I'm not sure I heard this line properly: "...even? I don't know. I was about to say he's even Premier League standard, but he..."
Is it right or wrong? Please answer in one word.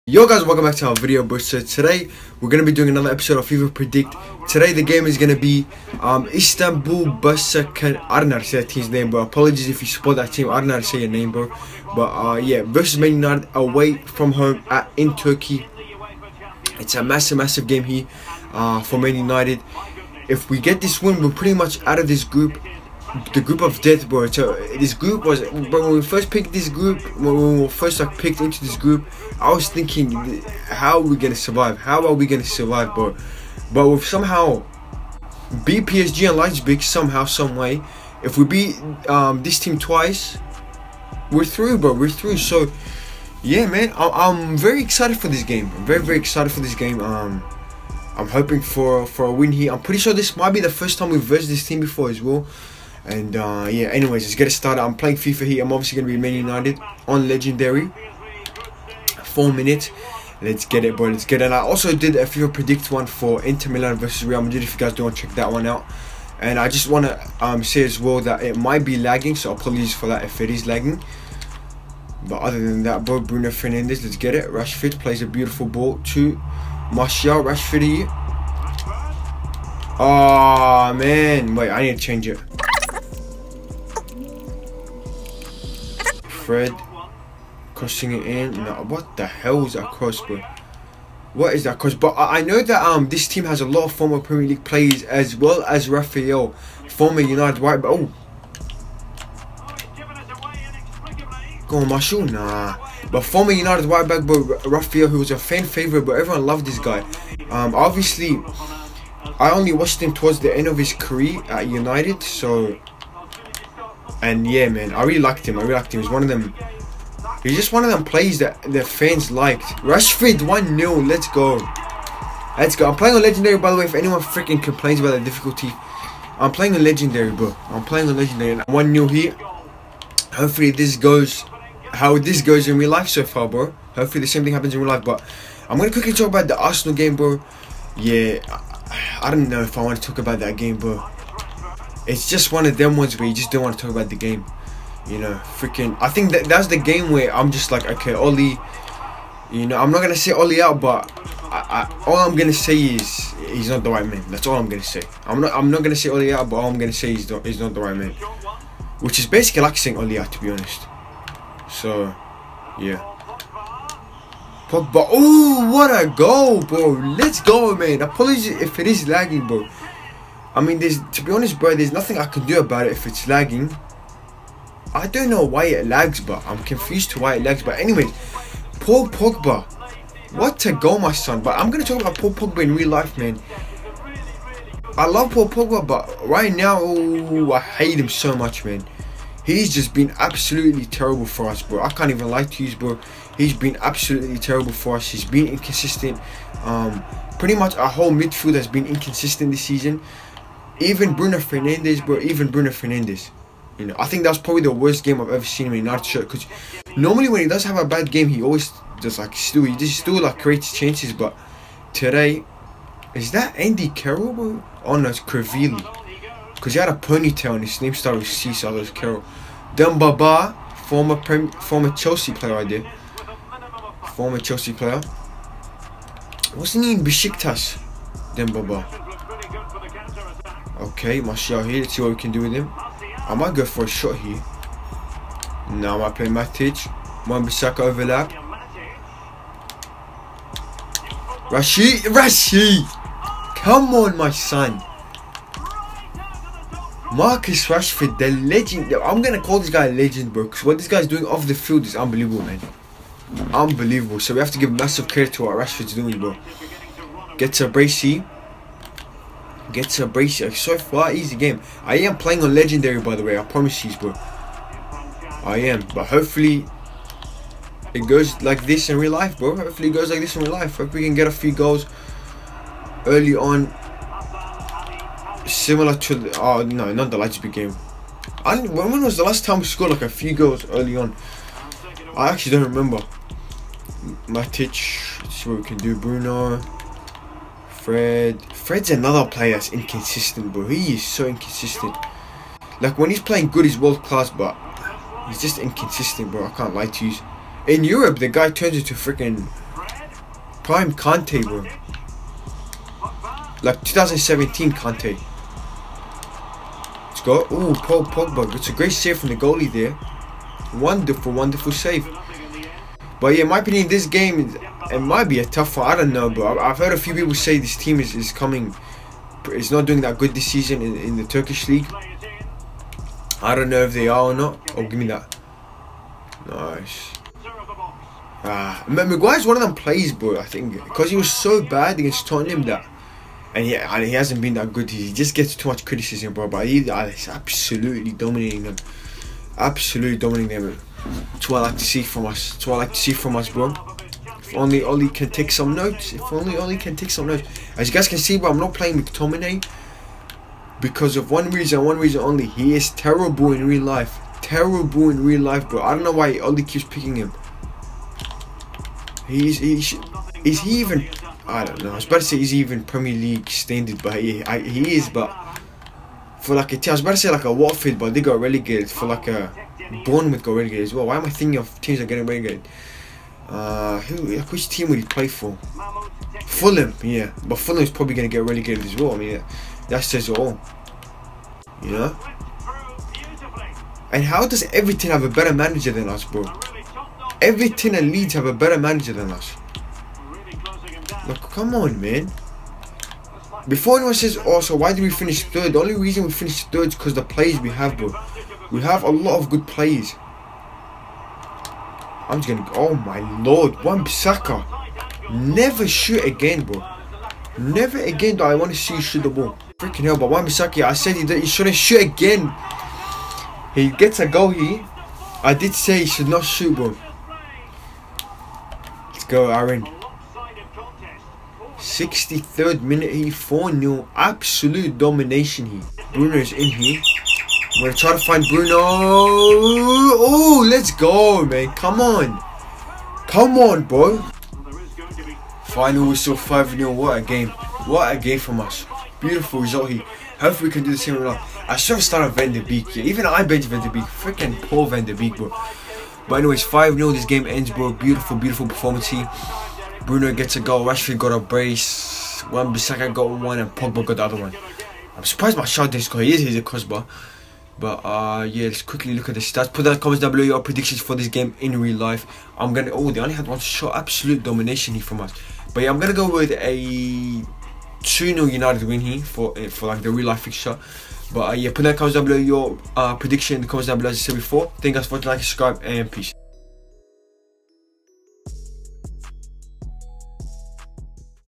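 right.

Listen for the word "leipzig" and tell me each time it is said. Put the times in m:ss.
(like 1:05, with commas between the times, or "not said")
0:36, 4:37.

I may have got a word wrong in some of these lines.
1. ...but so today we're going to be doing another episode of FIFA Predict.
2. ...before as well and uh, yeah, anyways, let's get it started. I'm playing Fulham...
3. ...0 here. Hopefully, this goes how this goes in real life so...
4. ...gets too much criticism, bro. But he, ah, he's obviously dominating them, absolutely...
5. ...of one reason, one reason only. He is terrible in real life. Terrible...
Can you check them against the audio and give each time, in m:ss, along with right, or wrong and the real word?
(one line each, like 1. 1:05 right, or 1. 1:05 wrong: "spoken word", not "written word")
1. 0:01 right
2. 0:51 wrong: "FIFA", not "Fulham"
3. 2:08 right
4. 5:35 wrong: "absolutely", not "obviously"
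5. 5:51 right.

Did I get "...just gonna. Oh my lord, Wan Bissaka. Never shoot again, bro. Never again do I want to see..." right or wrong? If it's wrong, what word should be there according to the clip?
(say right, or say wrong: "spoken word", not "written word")
right.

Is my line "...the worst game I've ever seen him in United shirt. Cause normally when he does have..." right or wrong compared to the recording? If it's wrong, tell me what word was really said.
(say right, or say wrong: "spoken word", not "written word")
right.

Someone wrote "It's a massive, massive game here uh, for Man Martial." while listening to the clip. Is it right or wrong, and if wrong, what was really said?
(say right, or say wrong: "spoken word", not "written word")
wrong: "United", not "Martial".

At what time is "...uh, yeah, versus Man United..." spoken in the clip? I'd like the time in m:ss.
0:12.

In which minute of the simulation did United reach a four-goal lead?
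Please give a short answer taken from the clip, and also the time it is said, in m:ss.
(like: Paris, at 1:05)
63rd minute, at 7:01.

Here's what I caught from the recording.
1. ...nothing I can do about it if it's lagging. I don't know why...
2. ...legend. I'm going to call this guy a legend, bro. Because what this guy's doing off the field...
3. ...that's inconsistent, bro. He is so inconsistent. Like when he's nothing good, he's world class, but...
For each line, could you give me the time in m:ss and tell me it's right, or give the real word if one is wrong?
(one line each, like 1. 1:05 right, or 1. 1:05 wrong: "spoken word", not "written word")
1. 2:51 right
2. 4:08 right
3. 4:49 wrong: "playing", not "nothing".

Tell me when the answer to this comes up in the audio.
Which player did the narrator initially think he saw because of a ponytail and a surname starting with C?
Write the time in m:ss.
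3:33.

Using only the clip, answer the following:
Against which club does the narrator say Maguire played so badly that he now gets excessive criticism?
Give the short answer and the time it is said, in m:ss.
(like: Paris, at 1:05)
Tottenham, at 5:32.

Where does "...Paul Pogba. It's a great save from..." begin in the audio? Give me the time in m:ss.
5:07.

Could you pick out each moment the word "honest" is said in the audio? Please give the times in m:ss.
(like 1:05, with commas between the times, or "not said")
2:40, 2:51.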